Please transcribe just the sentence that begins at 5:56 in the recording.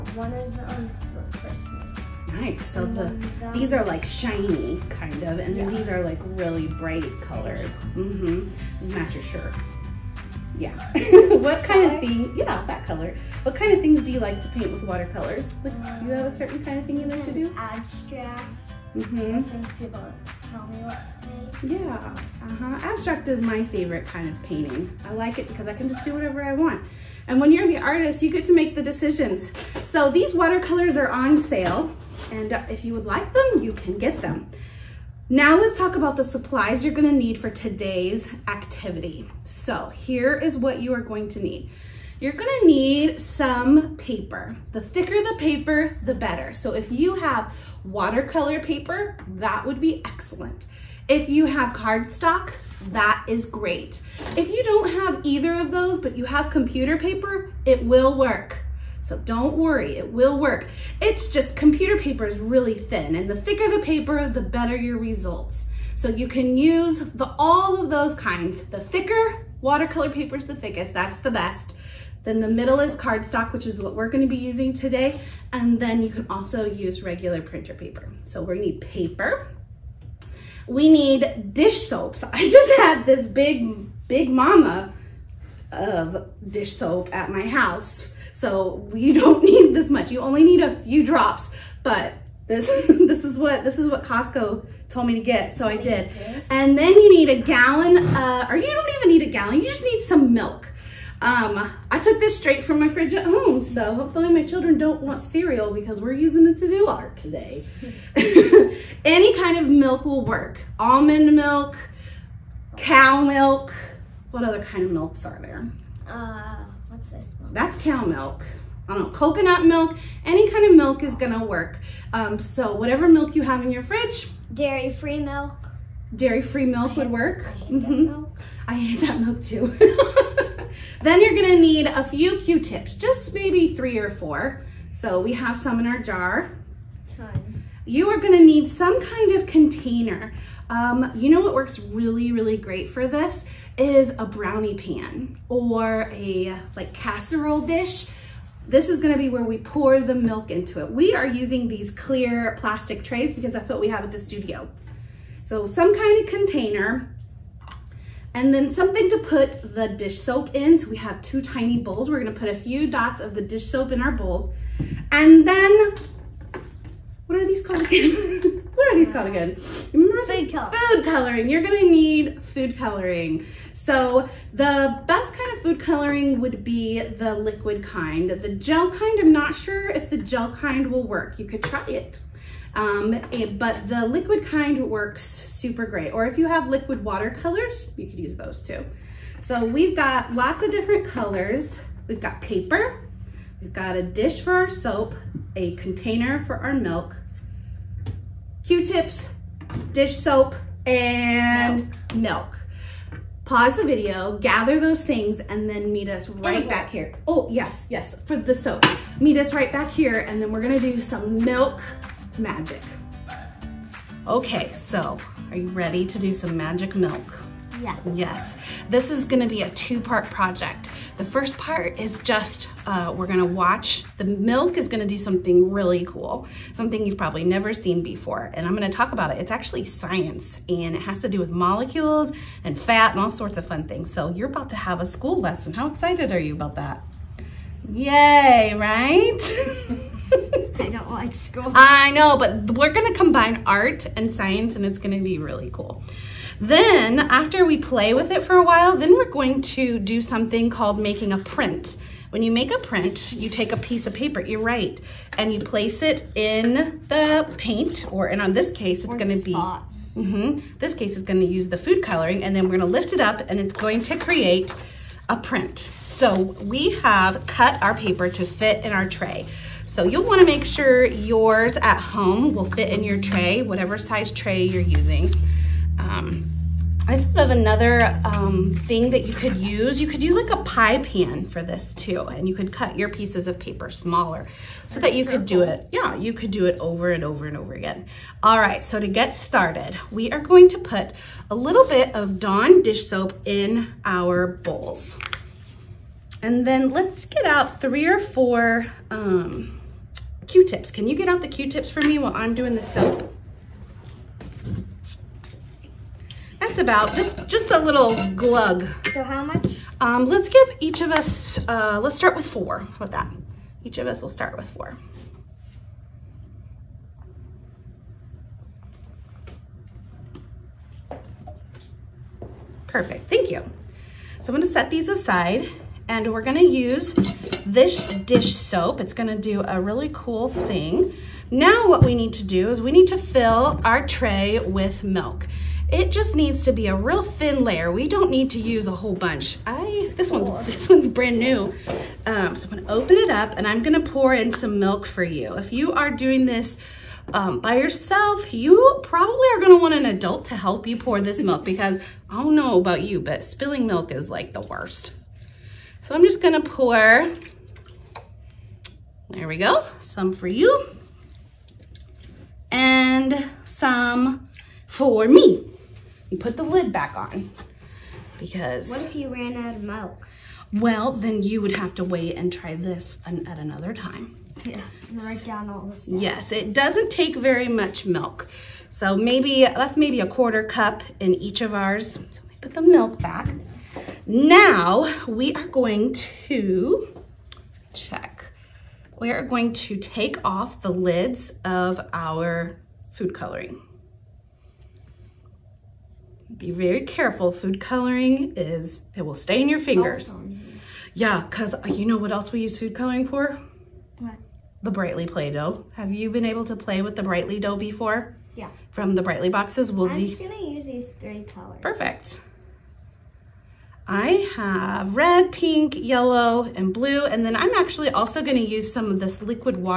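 So I'm just gonna pour, there we go, some for you and some for me.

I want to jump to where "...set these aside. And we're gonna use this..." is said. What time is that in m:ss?
5:24.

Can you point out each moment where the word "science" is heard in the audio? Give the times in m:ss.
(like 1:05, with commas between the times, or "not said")
3:49, 4:04.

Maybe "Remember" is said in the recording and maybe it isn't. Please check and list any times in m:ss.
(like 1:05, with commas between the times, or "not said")
2:49.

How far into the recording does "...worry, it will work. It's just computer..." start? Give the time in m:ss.
0:59.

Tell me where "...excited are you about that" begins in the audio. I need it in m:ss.
3:55.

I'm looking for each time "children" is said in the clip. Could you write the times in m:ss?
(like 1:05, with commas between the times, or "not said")
1:44.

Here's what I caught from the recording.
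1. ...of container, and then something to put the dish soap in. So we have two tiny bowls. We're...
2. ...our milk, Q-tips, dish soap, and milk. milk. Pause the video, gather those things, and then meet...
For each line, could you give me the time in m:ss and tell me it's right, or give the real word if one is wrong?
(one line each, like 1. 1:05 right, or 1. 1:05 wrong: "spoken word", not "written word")
1. 2:36 right
2. 3:16 right.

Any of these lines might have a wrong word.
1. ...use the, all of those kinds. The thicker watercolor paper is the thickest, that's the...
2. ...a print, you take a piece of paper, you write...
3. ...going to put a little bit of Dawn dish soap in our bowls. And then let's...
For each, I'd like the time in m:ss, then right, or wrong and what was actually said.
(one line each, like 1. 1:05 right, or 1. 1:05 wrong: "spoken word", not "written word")
1. 1:06 right
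2. 4:12 right
3. 4:50 right.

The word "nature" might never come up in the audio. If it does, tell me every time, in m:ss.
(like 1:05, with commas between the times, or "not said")
not said.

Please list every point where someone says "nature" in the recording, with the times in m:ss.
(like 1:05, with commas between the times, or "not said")
not said.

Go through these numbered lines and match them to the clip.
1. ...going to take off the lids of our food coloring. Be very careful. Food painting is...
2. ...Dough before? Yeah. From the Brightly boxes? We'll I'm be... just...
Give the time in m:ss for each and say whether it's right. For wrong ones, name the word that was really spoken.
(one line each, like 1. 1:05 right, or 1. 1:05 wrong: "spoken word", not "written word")
1. 6:29 wrong: "coloring", not "painting"
2. 6:47 right.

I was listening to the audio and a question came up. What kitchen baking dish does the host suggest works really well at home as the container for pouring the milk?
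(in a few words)
Brownie pan.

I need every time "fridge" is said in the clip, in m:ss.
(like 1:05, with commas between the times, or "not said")
1:42, 2:03.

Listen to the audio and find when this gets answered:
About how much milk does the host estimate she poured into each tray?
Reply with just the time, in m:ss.
6:20.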